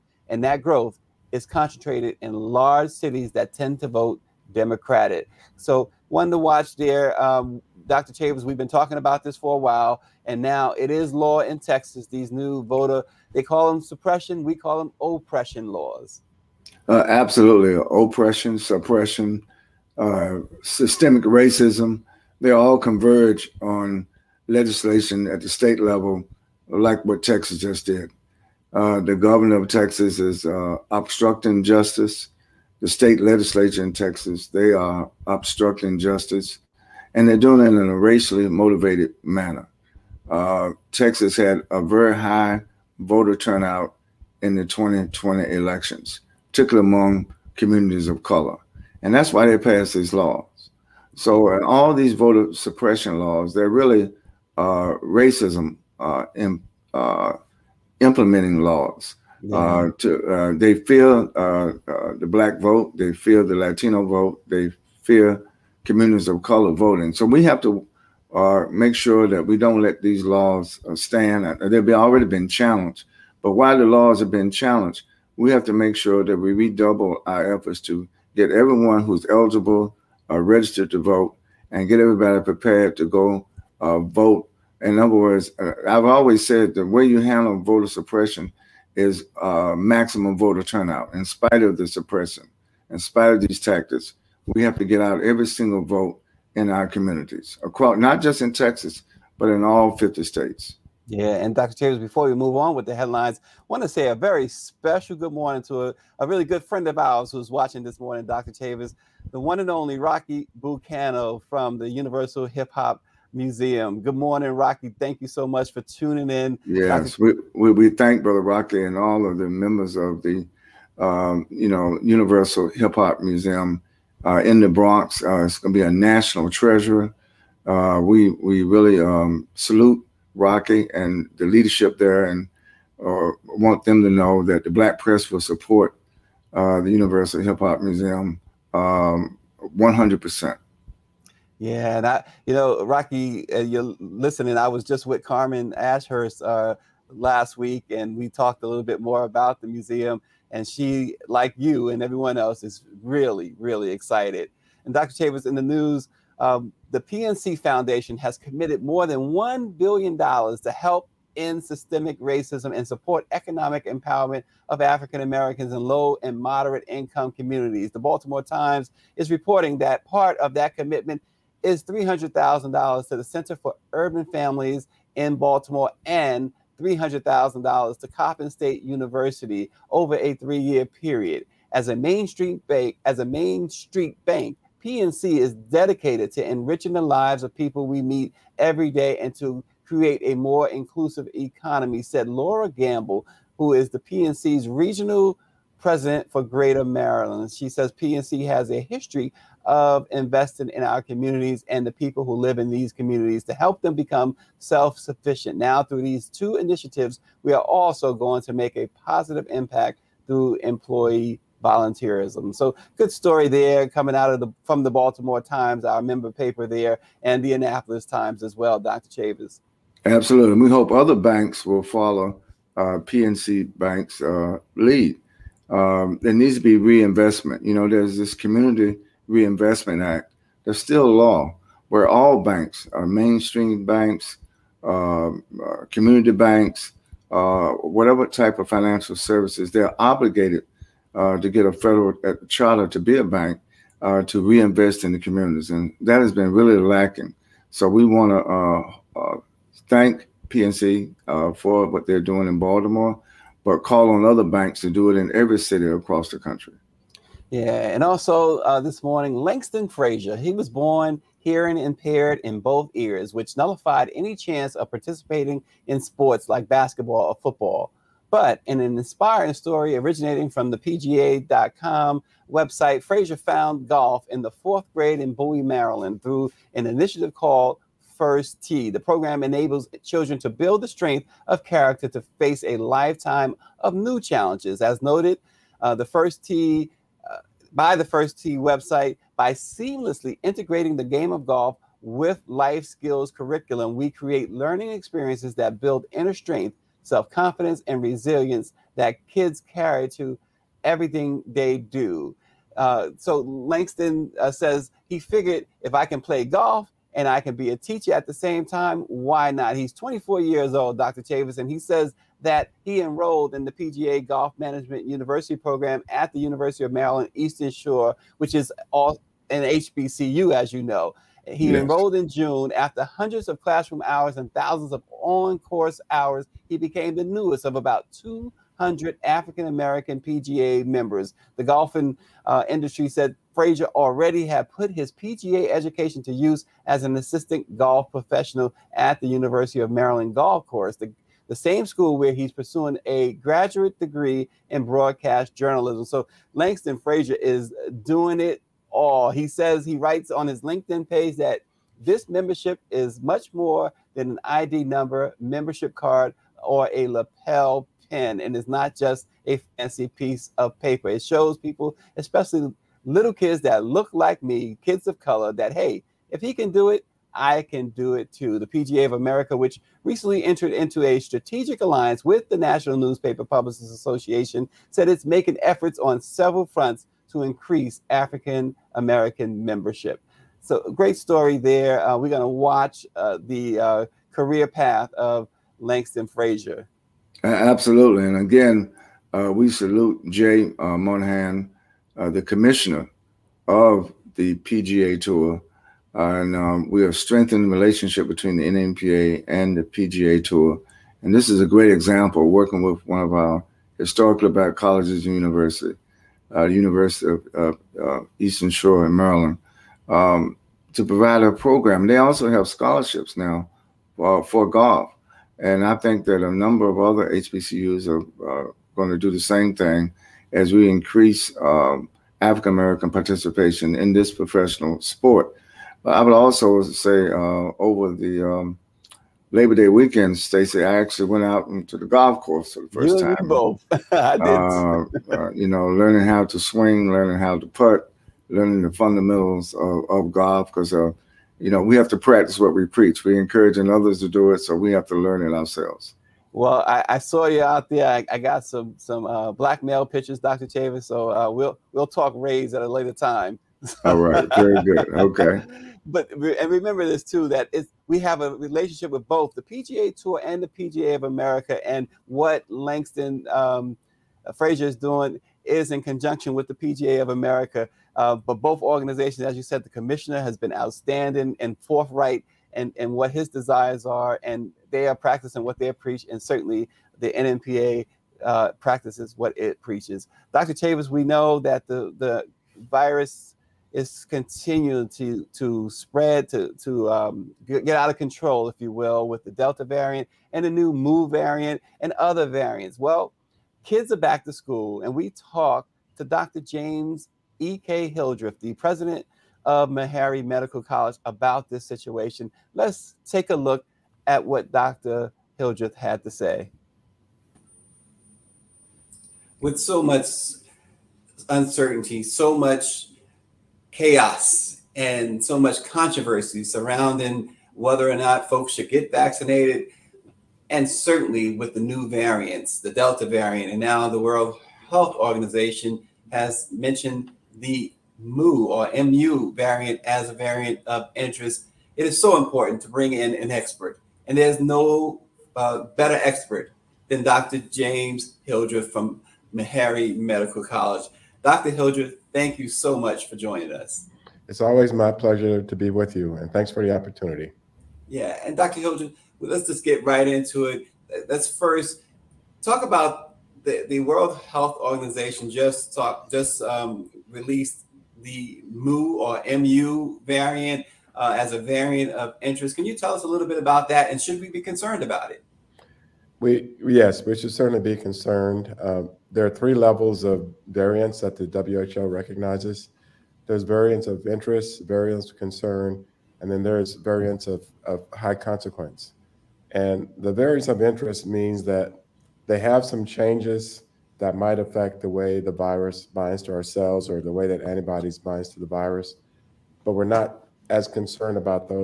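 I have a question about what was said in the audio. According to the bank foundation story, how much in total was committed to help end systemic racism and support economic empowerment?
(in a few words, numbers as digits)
more than $1 billion.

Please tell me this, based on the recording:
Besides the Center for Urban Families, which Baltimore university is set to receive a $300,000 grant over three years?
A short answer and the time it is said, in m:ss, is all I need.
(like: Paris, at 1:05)
Coppin State University, at 2:58.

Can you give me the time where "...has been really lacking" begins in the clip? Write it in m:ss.
4:06.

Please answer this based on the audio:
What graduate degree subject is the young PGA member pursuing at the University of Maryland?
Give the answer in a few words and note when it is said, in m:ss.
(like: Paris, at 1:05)
broadcast journalism, at 5:44.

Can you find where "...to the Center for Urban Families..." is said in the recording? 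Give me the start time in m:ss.
2:53.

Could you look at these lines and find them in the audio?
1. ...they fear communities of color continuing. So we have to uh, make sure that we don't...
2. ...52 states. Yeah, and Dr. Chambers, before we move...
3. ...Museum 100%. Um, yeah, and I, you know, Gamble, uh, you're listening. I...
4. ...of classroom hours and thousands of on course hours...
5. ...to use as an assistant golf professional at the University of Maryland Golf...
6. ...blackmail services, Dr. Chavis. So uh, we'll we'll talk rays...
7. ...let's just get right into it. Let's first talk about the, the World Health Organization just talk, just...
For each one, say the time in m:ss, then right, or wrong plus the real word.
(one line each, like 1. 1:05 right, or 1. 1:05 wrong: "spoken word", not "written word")
1. 1:04 wrong: "voting", not "continuing"
2. 1:39 wrong: "50", not "52"
3. 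2:17 wrong: "Rocky", not "Gamble"
4. 5:23 right
5. 5:36 right
6. 7:29 wrong: "pictures", not "services"
7. 9:09 right.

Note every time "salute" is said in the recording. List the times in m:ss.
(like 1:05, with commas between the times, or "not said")
2:09, 6:29.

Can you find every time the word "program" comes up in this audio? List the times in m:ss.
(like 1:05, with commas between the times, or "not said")
4:38, 5:15, 6:51.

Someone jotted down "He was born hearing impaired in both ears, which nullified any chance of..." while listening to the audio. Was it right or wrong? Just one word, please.
right.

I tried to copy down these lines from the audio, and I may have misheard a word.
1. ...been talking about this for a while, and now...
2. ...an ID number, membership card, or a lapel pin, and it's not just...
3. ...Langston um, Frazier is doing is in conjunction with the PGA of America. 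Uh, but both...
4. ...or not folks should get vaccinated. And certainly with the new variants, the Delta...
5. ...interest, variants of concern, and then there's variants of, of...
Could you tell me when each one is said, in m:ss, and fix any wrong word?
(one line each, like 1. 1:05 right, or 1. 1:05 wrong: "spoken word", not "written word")
1. 0:08 right
2. 5:54 right
3. 7:42 right
4. 8:38 right
5. 9:34 right.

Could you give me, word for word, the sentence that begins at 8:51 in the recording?
It is so important to bring in an expert.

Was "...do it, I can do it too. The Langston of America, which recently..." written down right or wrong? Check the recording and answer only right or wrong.
wrong.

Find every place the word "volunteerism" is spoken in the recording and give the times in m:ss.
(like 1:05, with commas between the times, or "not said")
3:31.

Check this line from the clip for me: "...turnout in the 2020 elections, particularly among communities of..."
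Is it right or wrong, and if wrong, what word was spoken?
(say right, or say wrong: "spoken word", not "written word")
right.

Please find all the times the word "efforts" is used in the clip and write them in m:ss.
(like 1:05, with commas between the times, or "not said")
1:17, 6:15.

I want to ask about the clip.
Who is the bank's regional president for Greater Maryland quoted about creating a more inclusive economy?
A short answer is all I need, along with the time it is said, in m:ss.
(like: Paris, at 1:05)
Laura Gamble, at 3:12.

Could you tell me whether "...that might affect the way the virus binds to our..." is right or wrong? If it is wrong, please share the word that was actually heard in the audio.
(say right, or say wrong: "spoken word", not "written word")
right.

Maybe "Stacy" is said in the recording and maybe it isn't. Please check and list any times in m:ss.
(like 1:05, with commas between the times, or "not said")
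7:10.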